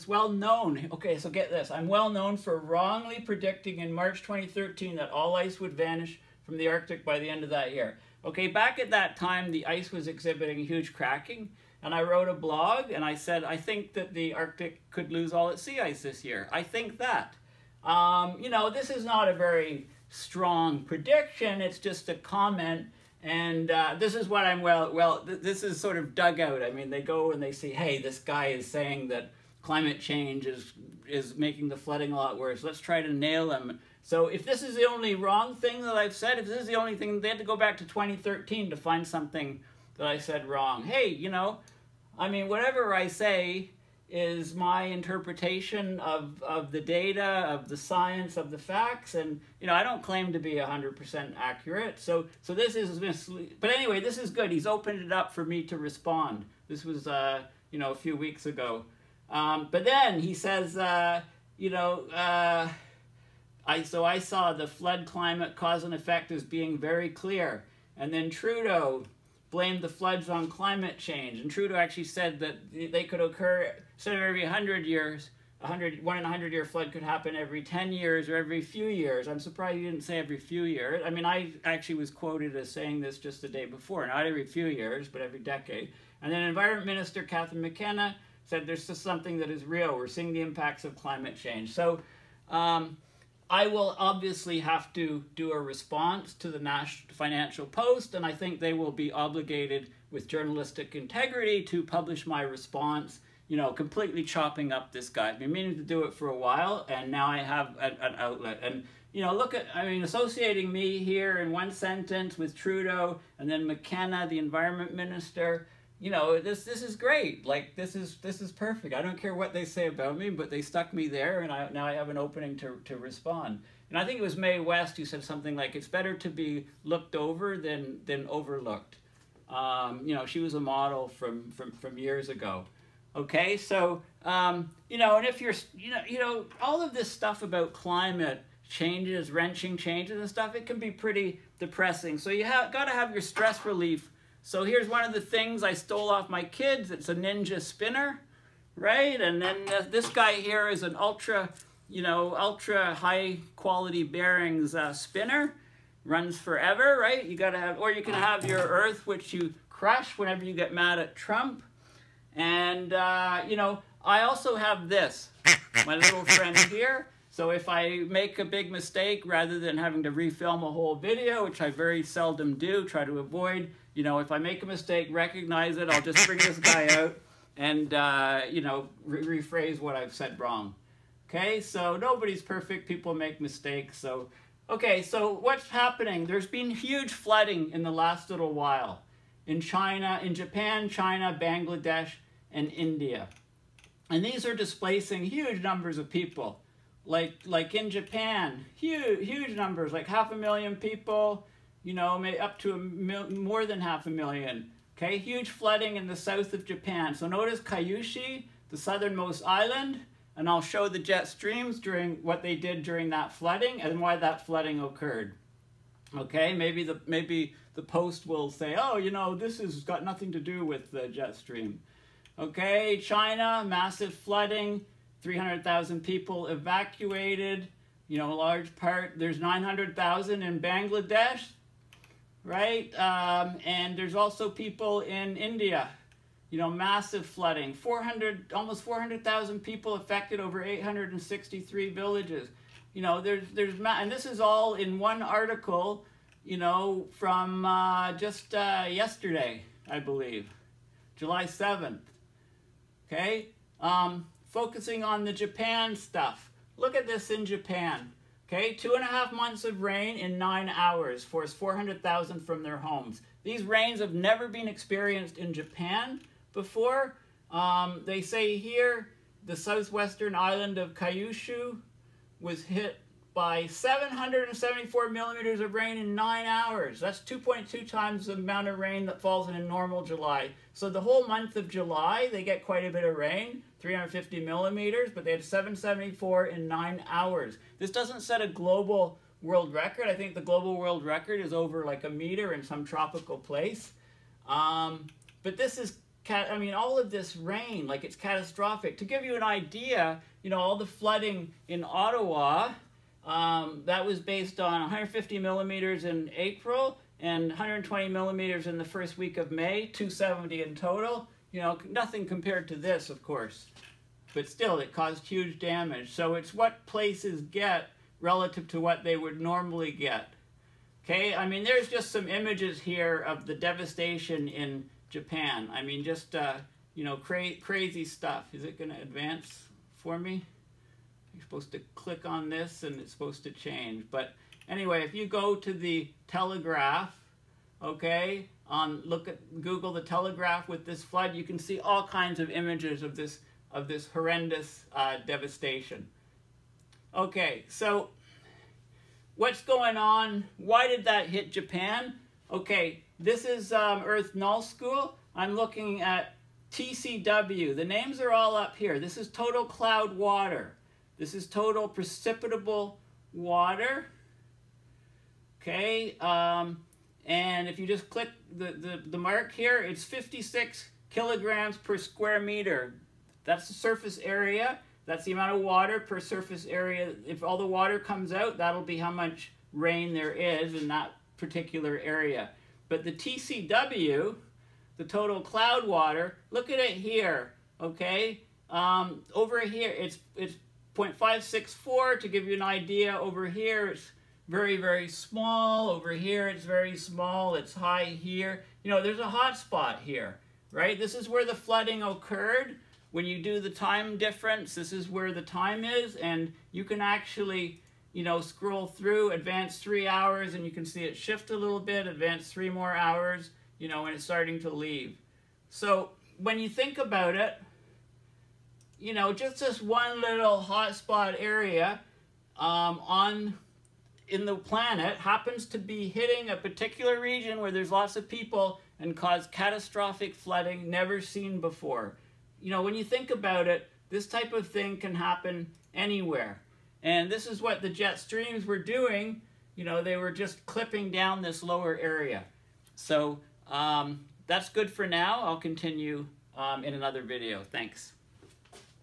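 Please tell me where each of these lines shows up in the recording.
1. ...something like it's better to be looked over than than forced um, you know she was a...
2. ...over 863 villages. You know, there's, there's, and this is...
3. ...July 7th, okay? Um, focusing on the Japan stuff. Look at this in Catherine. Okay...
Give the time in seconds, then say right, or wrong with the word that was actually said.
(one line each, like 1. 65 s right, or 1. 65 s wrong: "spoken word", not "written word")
1. 125 s wrong: "overlooked", not "forced"
2. 240 s right
3. 251 s wrong: "Japan", not "Catherine".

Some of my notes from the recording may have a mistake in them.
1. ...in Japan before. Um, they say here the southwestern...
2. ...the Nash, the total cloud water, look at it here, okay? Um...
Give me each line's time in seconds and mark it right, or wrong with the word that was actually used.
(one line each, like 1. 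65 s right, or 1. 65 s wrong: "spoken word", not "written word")
1. 265 s right
2. 383 s wrong: "TCW", not "Nash".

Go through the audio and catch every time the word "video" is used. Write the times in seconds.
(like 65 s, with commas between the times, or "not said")
170 s, 447 s.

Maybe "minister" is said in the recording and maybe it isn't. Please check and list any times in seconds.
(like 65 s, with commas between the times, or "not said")
86 s, 114 s.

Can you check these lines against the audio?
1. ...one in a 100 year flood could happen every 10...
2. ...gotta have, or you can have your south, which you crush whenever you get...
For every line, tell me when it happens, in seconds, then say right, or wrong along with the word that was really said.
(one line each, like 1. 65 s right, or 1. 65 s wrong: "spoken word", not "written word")
1. 76 s right
2. 157 s wrong: "earth", not "south".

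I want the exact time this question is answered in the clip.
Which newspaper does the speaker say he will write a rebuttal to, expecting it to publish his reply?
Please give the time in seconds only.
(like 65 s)
97 s.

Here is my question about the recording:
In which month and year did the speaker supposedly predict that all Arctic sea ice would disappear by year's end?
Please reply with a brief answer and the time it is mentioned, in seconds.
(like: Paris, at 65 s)
March 2013, at 3 s.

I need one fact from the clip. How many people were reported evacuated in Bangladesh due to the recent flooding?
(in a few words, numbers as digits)
900,000.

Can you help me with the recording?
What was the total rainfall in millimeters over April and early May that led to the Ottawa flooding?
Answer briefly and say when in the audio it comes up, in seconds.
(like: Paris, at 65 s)
270, at 309 s.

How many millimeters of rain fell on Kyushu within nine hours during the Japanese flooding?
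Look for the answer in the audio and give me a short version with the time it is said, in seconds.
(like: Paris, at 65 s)
774, at 273 s.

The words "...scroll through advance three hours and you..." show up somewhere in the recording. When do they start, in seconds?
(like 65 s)
408 s.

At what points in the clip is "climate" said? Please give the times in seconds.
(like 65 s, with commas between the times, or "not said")
29 s, 65 s, 70 s, 90 s, 137 s.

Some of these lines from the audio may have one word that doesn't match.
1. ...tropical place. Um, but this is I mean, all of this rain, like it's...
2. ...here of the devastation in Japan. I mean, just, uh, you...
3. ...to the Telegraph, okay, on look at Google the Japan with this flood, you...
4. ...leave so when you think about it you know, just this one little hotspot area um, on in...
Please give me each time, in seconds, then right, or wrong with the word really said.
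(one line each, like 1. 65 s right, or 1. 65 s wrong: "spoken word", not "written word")
1. 292 s right
2. 322 s right
3. 335 s wrong: "Telegraph", not "Japan"
4. 414 s right.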